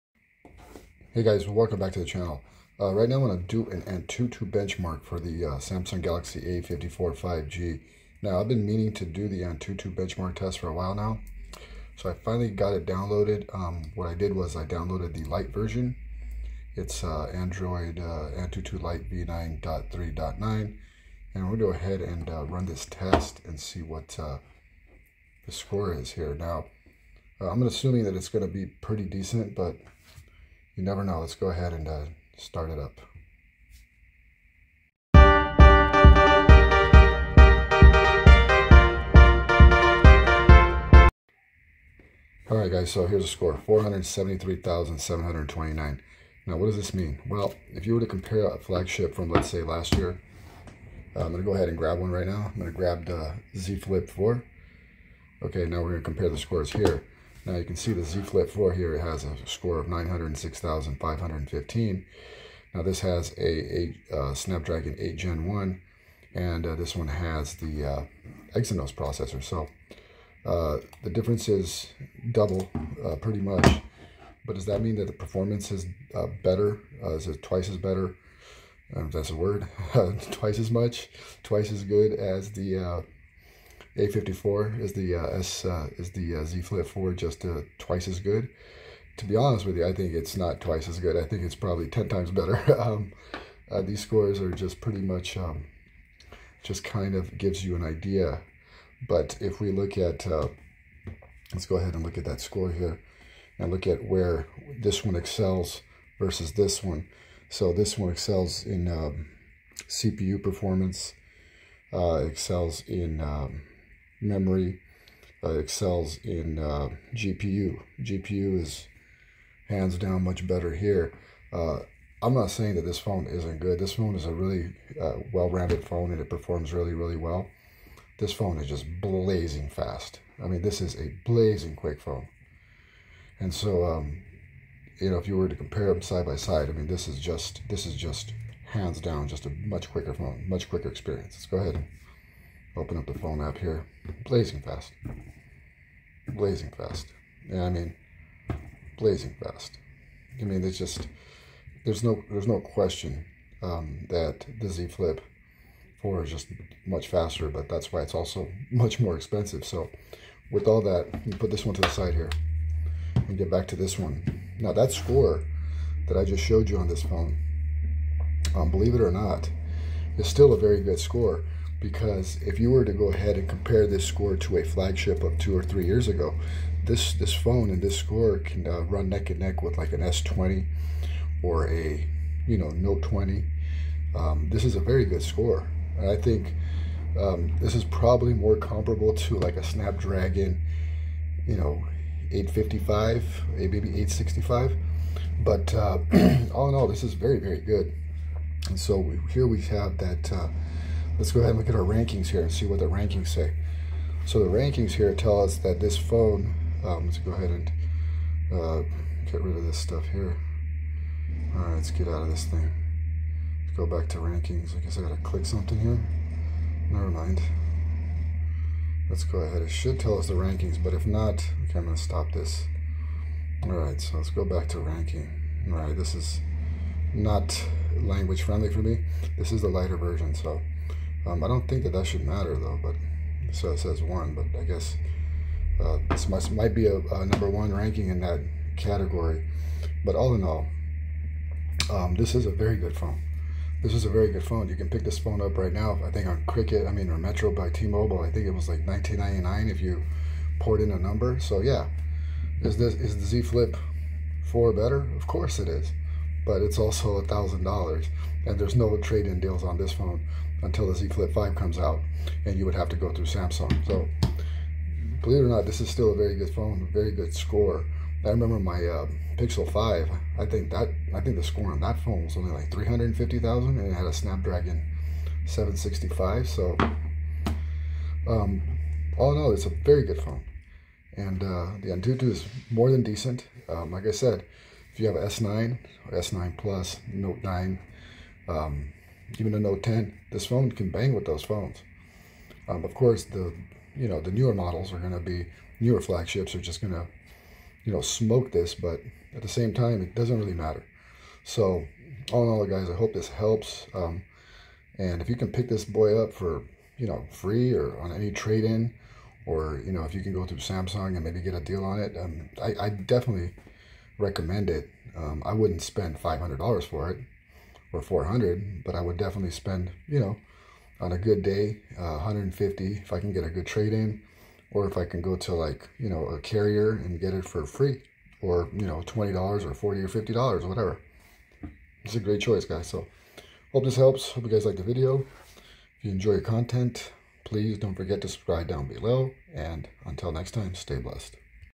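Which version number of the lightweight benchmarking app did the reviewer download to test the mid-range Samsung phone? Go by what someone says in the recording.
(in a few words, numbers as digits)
V9.3.9.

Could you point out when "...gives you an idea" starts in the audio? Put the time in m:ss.
1:37.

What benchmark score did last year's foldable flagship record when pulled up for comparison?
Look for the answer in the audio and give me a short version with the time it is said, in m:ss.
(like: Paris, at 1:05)
906,515, at 0:59.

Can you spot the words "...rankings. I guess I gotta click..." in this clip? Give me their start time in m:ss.
3:34.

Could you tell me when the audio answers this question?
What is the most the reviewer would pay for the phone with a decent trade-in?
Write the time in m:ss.
5:22.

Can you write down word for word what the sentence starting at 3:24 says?
So the rankings here tell us that this phone, um, let's go ahead and uh, get rid of this stuff here.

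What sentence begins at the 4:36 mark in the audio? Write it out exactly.
So, um, all in all, it's a very good phone, and uh, the Antutu is more than decent.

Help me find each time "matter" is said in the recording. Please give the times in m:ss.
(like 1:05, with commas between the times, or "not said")
3:52, 5:00.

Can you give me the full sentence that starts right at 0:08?
Now I've been meaning to do the Antutu benchmark test for a while now.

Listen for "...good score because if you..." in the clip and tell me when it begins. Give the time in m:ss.
2:50.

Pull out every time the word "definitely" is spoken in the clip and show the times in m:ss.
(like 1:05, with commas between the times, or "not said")
5:12, 5:19.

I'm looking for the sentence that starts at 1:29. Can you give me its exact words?
To be honest with you, I think it's not twice as good.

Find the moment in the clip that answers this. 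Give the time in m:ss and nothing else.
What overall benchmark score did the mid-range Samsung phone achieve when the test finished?
0:43.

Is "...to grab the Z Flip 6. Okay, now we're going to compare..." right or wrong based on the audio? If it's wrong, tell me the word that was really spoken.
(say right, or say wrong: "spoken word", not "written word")
wrong: "4", not "6".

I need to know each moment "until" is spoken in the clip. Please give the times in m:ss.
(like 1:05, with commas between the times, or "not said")
4:20, 5:40.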